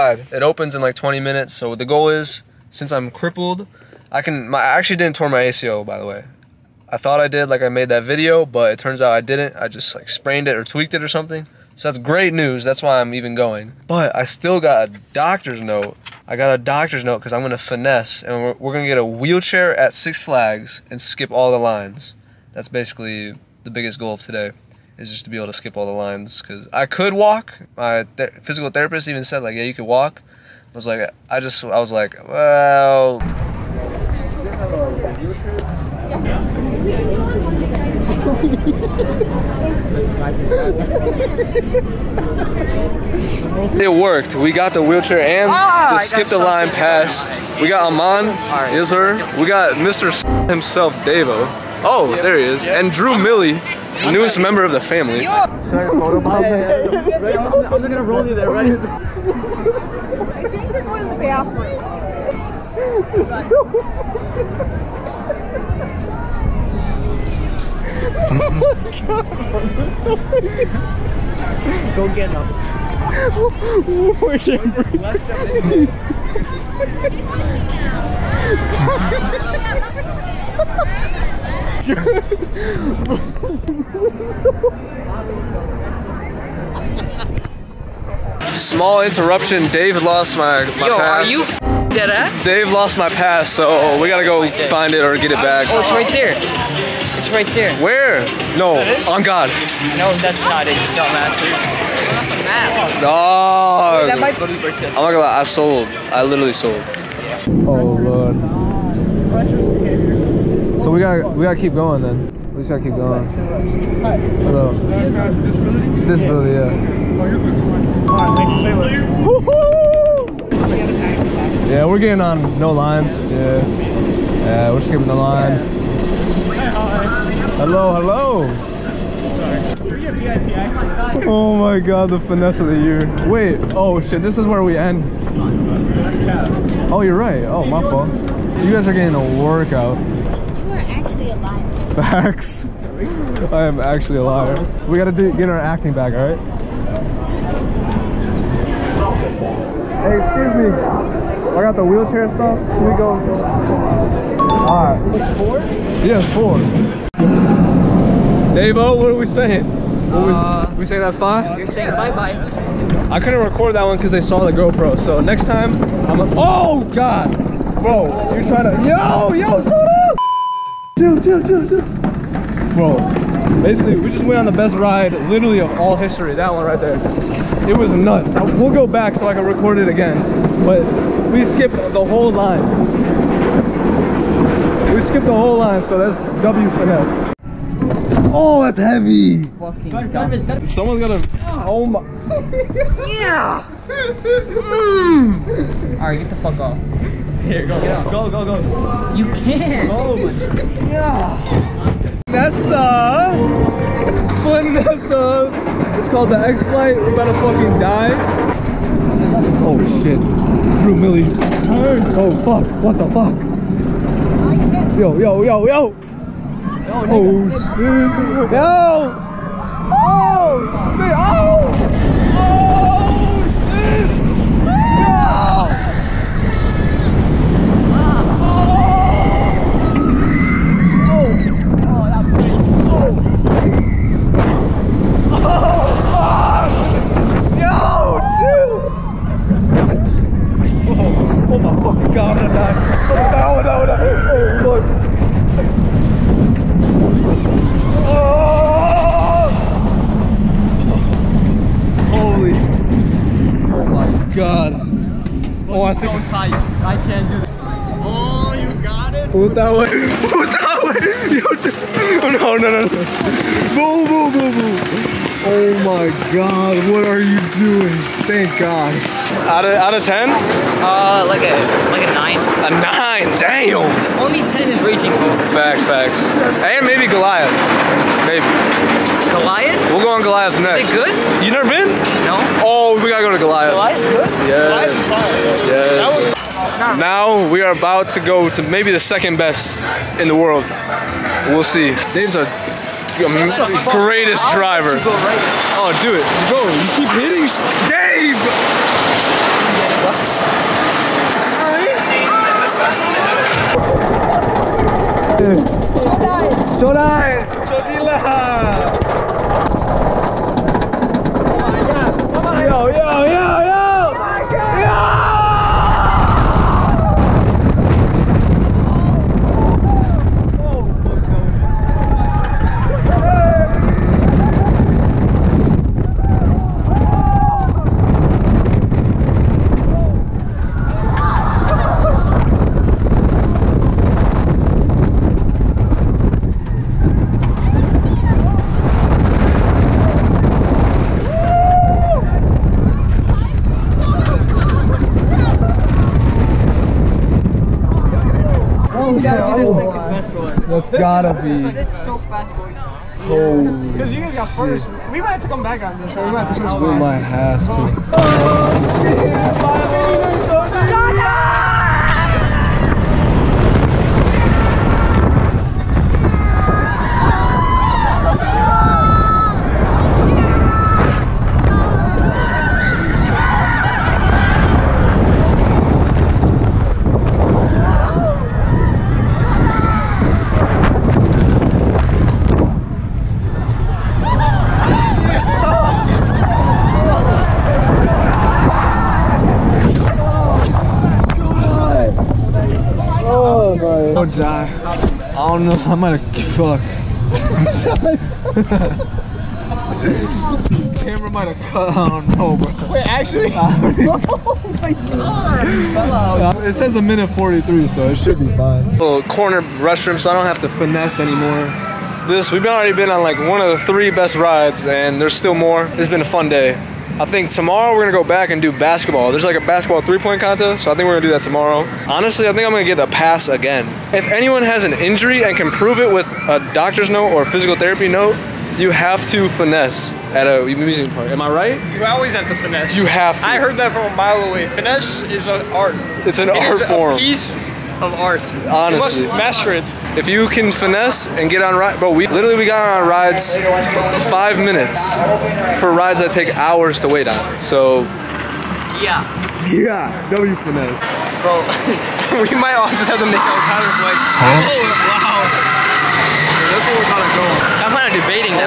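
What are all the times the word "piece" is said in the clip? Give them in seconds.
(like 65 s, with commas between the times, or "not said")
437 s.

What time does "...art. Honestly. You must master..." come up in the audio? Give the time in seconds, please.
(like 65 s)
438 s.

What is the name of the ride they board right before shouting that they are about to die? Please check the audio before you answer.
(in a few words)
X Flight.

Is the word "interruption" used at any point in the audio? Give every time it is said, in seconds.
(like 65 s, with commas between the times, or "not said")
89 s.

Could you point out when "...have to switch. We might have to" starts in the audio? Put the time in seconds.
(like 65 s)
356 s.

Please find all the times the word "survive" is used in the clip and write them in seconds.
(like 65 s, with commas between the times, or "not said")
not said.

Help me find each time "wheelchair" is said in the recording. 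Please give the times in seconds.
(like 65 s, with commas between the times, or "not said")
19 s, 44 s, 151 s.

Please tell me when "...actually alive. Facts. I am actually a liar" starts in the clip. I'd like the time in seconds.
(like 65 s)
140 s.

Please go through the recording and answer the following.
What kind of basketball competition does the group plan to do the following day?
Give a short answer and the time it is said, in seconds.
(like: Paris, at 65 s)
three-point contest, at 420 s.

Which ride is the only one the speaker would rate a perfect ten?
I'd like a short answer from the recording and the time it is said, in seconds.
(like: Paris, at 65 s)
Raging Bull, at 274 s.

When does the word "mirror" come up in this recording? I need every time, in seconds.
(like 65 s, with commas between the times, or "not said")
not said.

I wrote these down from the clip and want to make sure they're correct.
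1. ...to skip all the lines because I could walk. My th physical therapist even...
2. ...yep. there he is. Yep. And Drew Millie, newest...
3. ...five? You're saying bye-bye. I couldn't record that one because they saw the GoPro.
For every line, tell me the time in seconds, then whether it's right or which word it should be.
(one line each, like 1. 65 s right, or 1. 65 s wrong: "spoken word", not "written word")
1. 25 s right
2. 52 s right
3. 161 s right.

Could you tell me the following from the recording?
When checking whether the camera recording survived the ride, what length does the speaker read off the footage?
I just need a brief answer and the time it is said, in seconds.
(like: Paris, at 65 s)
1 minute 43, at 406 s.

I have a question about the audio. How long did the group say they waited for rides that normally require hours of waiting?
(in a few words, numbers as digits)
5 minutes.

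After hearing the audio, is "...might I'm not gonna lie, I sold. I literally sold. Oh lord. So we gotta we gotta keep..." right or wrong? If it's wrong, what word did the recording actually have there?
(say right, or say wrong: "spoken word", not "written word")
right.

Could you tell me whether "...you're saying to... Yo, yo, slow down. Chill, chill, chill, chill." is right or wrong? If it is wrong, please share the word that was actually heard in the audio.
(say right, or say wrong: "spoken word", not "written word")
wrong: "trying", not "saying".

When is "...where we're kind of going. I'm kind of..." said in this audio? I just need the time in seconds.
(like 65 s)
456 s.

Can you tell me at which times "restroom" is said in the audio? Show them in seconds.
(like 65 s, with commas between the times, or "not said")
409 s.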